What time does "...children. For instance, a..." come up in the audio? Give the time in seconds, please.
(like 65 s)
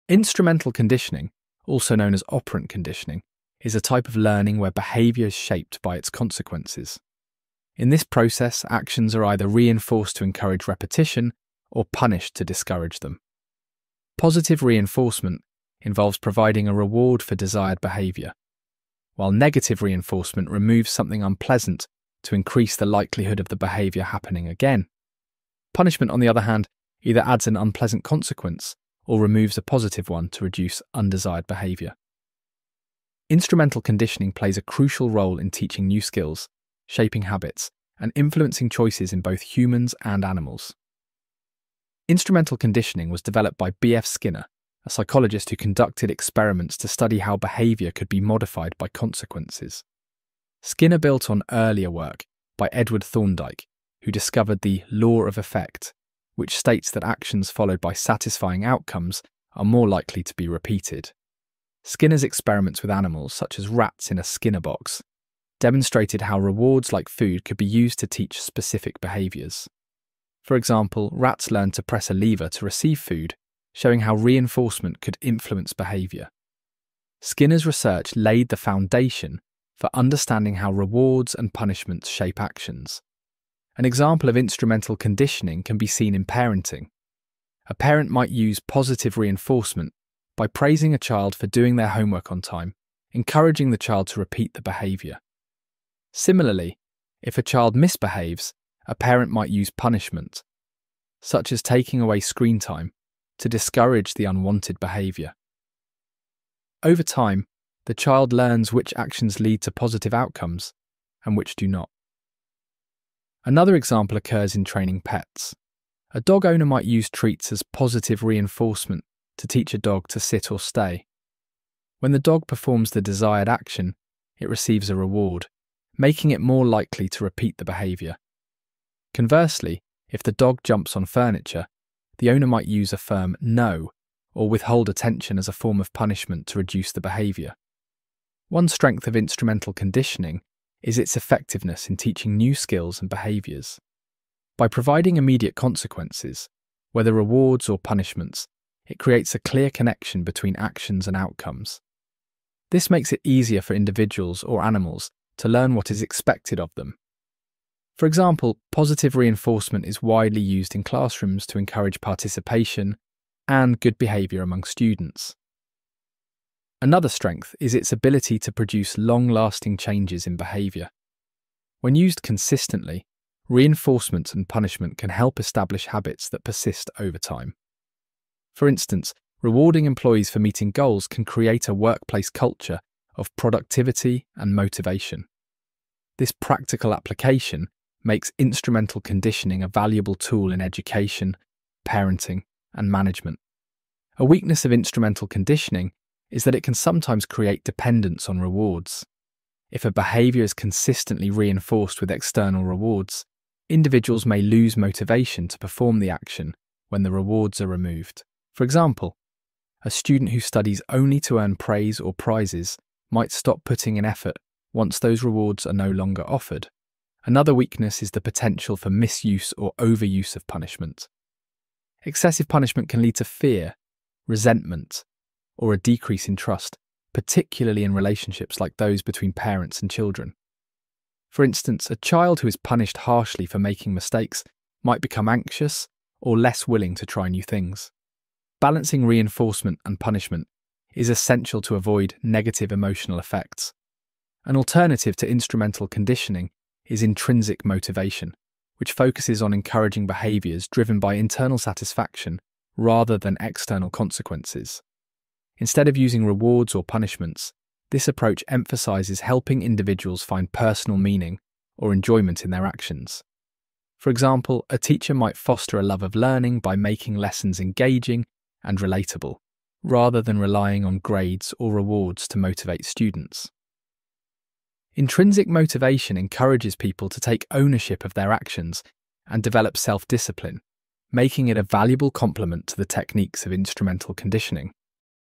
229 s.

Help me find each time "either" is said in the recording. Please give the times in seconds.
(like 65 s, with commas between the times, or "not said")
9 s, 27 s.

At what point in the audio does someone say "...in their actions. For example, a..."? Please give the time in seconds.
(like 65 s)
262 s.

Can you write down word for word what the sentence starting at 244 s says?
An alternative to instrumental conditioning is intrinsic motivation, which focuses on encouraging behaviours driven by internal satisfaction rather than external consequences.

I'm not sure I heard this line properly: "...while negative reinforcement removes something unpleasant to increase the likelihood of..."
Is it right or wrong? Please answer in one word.
right.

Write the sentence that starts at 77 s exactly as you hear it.
Skinner's research laid the foundation for understanding how rewards and punishments shape actions.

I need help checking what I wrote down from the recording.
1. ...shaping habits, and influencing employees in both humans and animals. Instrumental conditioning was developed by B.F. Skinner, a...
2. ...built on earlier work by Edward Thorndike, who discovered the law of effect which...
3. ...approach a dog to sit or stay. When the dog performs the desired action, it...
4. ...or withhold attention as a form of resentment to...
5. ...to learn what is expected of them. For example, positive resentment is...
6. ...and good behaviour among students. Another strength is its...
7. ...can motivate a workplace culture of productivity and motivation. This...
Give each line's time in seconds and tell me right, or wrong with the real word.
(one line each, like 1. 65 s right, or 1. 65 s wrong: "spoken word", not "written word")
1. 36 s wrong: "choices", not "employees"
2. 50 s right
3. 119 s wrong: "teach", not "approach"
4. 134 s wrong: "punishment", not "resentment"
5. 155 s wrong: "reinforcement", not "resentment"
6. 163 s right
7. 181 s wrong: "create", not "motivate".